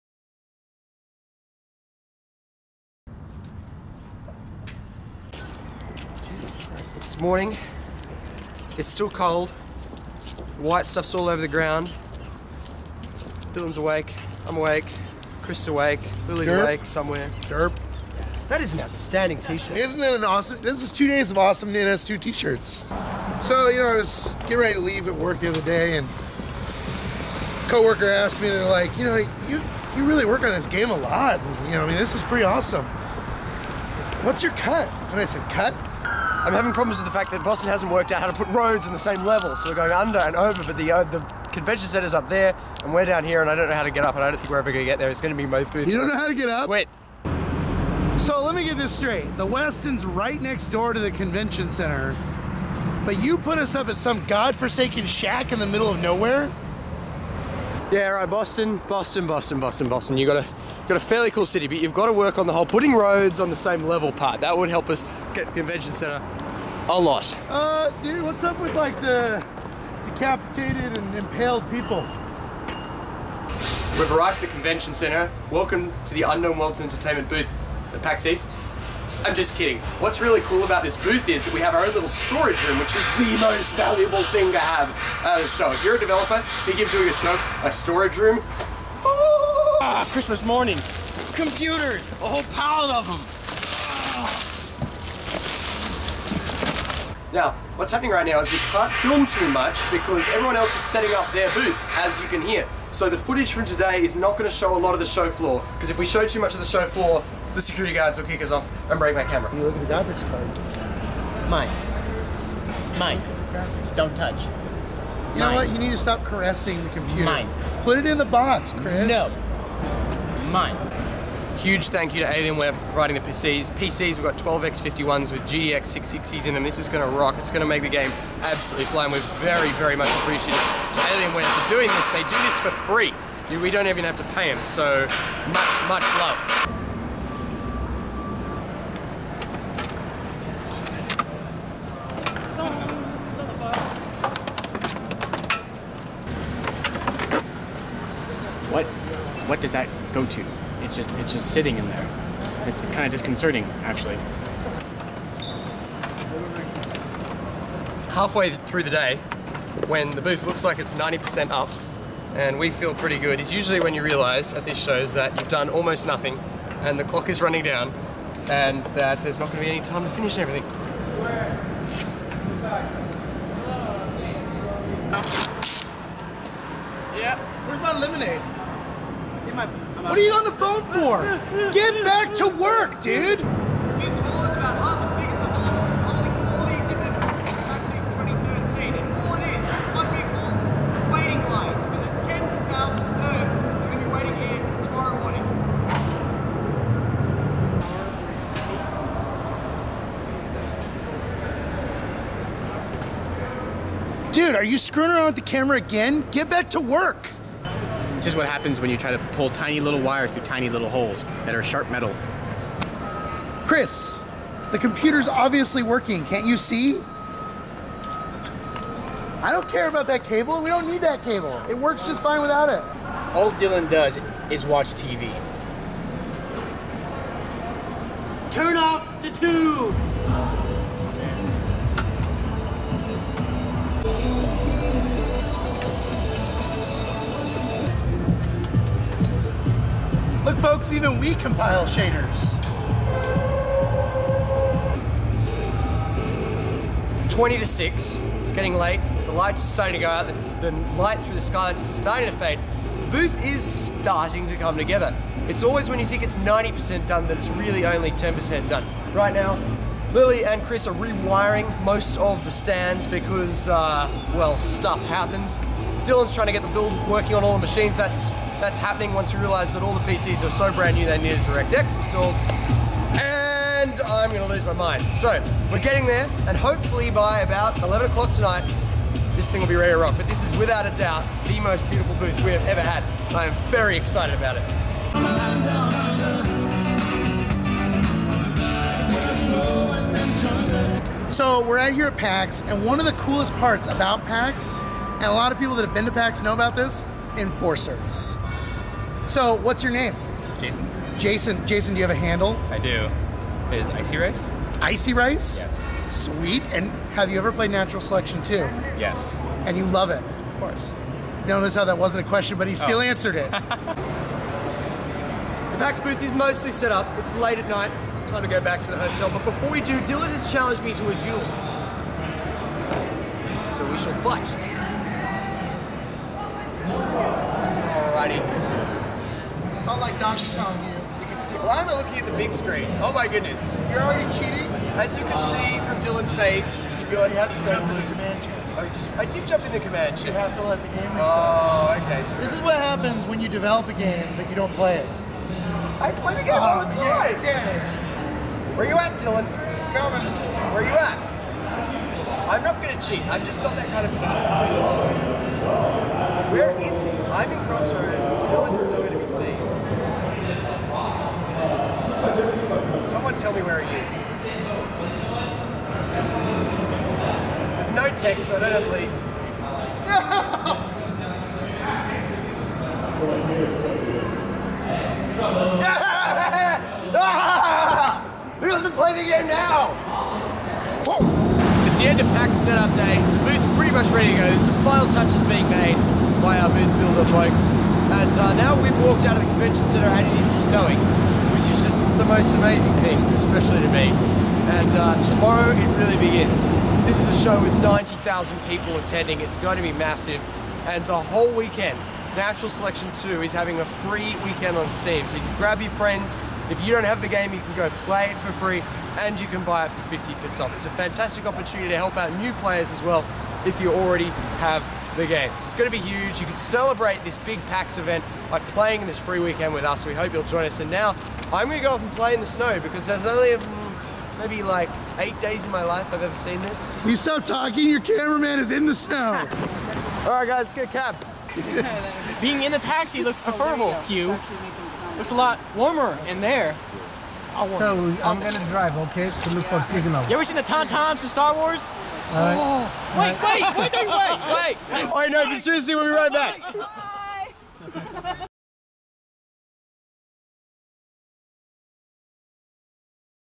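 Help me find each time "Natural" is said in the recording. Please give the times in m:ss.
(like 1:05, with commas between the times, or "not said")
5:07, 6:42.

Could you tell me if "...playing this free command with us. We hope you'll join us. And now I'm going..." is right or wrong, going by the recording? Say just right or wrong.
wrong.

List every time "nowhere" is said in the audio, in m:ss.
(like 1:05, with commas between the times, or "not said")
0:56, 5:58.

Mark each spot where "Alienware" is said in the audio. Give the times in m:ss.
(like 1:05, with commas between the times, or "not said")
2:02, 2:10.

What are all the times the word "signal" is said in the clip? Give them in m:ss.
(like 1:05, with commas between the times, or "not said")
7:19.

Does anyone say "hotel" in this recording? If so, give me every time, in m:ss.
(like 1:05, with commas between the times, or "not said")
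5:18.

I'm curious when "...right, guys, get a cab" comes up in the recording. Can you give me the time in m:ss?
7:10.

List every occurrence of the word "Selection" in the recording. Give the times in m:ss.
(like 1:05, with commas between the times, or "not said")
5:08, 6:42.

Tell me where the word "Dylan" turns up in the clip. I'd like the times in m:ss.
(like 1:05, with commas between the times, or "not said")
0:13, 3:43, 4:26, 5:20, 5:36, 5:49, 5:58.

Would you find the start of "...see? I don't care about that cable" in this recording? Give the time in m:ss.
3:36.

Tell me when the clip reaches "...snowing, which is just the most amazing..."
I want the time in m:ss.
6:30.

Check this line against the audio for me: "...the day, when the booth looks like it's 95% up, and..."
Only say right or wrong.
wrong.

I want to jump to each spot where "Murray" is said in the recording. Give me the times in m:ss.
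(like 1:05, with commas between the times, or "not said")
not said.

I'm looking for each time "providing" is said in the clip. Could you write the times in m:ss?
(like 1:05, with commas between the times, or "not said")
2:02.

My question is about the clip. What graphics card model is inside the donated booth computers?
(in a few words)
GTX 660.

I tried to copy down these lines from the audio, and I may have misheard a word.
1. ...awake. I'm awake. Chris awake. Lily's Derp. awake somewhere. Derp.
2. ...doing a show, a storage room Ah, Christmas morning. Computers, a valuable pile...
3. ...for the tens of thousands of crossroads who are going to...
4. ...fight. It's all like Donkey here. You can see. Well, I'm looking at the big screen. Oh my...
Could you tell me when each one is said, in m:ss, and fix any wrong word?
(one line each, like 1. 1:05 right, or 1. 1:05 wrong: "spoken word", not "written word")
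1. 0:13 right
2. 1:26 wrong: "whole", not "valuable"
3. 3:11 wrong: "nerds", not "crossroads"
4. 5:24 right.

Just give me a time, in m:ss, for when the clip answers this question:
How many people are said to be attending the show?
6:37.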